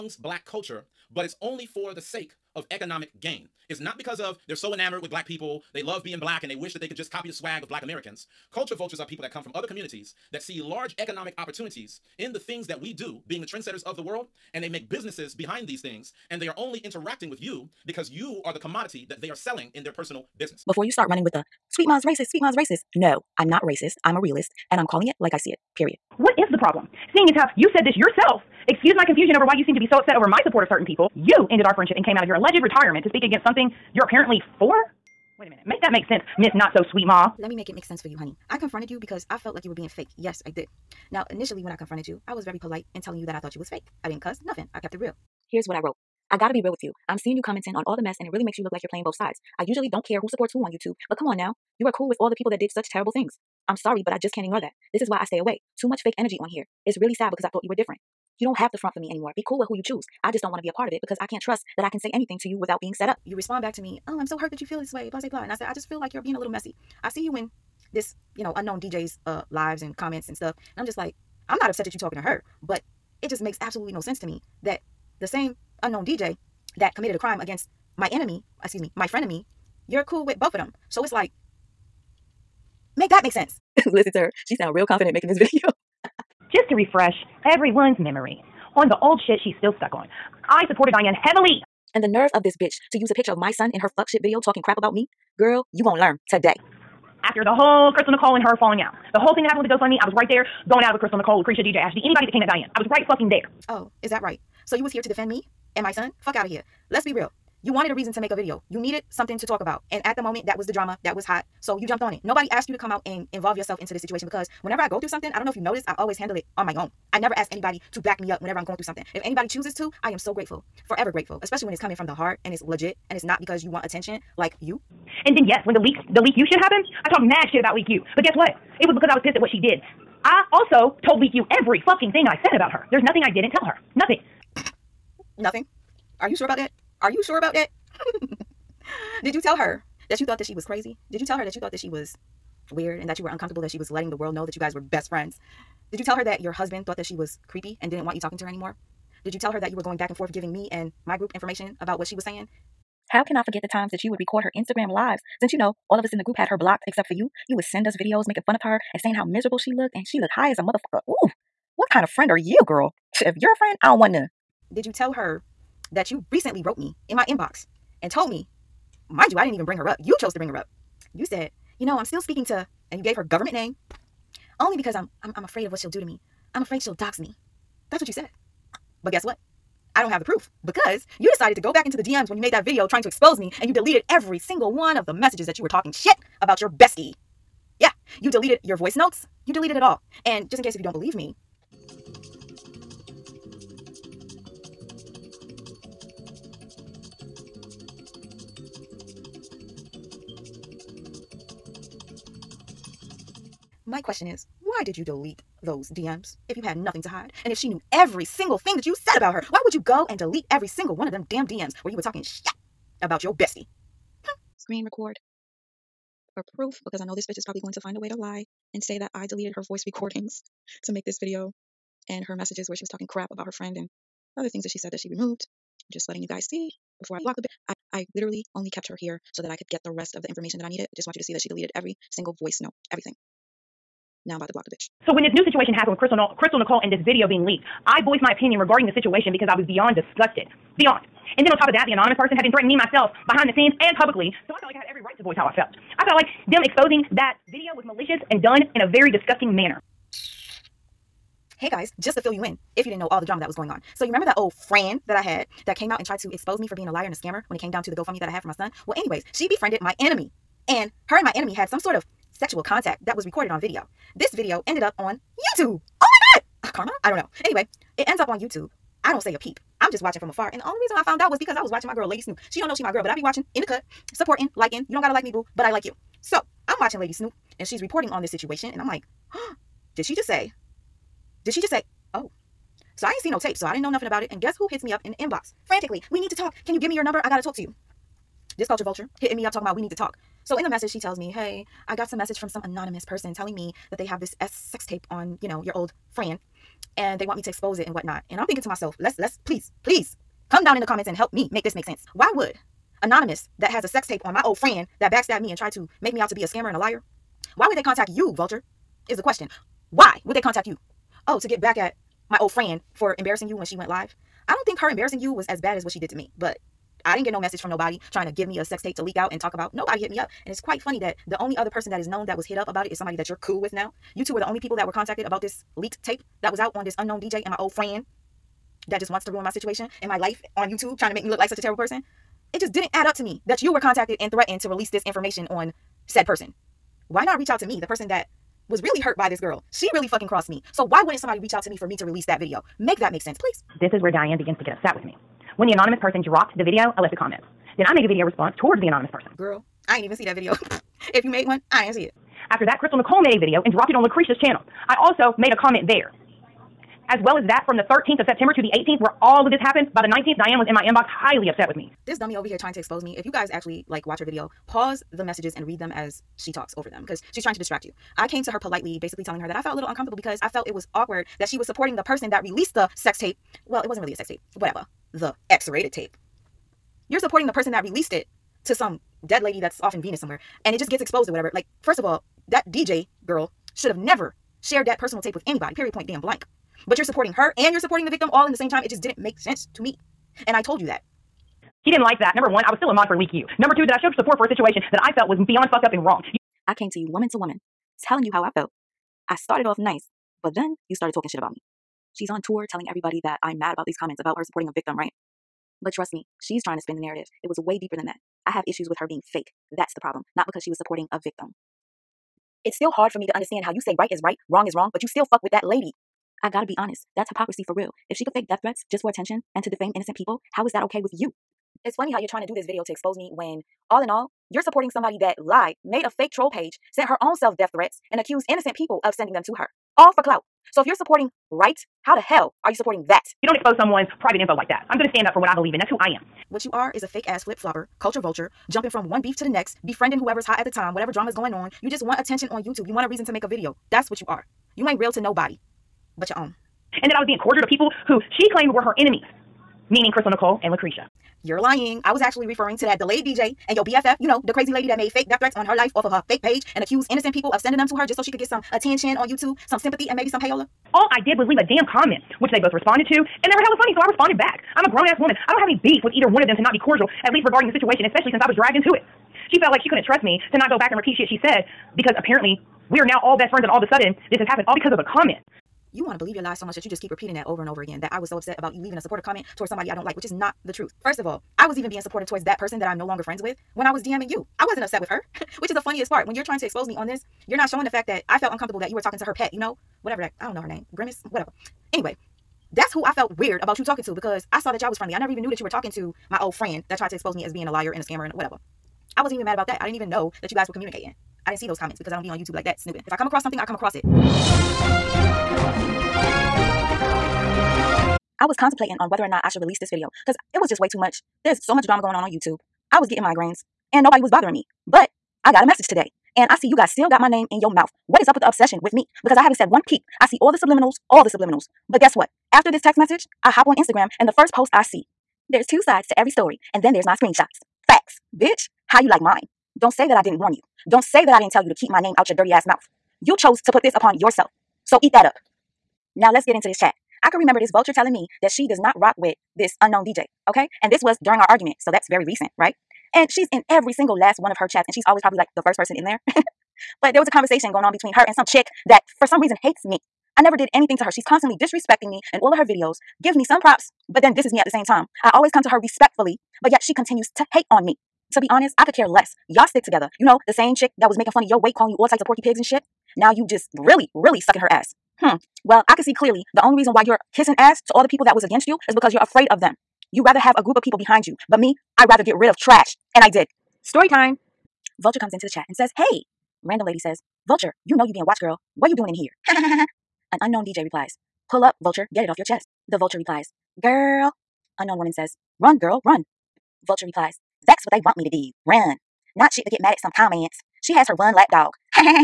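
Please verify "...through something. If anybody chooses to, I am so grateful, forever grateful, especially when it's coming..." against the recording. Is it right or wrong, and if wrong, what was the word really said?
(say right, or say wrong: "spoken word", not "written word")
right.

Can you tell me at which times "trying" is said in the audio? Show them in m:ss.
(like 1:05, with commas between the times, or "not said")
3:02, 5:18, 5:30, 6:02, 6:07, 6:46, 7:02, 8:06.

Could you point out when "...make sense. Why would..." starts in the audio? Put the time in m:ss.
5:01.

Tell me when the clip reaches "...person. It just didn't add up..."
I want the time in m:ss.
5:31.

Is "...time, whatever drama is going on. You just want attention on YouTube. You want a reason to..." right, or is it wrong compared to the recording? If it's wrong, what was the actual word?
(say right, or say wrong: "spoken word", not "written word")
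right.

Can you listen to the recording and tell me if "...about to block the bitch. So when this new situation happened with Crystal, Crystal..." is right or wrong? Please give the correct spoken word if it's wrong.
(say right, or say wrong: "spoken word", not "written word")
right.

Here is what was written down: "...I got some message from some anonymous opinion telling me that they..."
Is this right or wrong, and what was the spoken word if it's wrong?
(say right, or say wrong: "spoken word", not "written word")
wrong: "person", not "opinion".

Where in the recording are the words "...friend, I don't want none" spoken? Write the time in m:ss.
2:43.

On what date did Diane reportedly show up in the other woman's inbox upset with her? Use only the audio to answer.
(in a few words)
19th.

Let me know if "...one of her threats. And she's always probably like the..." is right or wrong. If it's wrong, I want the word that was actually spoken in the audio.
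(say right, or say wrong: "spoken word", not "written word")
wrong: "chats", not "threats".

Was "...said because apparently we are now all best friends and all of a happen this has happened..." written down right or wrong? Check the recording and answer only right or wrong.
wrong.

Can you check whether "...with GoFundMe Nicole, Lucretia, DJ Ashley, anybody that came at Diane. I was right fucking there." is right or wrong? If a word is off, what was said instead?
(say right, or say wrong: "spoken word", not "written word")
wrong: "Crystal", not "GoFundMe".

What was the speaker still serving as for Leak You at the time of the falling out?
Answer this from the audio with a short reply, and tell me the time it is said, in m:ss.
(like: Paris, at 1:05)
a mod, at 6:32.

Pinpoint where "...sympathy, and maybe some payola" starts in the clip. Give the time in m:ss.
7:39.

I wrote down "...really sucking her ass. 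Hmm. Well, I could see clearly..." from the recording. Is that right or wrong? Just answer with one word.
right.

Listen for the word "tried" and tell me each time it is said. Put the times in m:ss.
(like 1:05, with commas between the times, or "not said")
4:16, 5:05, 8:16.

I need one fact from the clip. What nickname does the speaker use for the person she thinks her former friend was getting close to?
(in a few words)
Grimace.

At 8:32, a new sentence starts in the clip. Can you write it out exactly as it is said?
I was getting migraines and nobody was bothering me.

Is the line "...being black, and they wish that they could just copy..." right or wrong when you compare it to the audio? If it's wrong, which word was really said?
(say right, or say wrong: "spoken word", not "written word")
right.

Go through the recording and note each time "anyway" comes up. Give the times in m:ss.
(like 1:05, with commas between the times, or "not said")
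4:18, 4:27, 8:11.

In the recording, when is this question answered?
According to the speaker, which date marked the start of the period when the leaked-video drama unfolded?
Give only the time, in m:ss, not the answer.
5:57.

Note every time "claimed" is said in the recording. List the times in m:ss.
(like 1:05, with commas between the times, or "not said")
7:28.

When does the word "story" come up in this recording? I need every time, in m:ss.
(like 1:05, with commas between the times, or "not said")
8:46, 9:33.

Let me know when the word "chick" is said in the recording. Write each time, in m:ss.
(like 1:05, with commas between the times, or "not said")
9:08, 9:20.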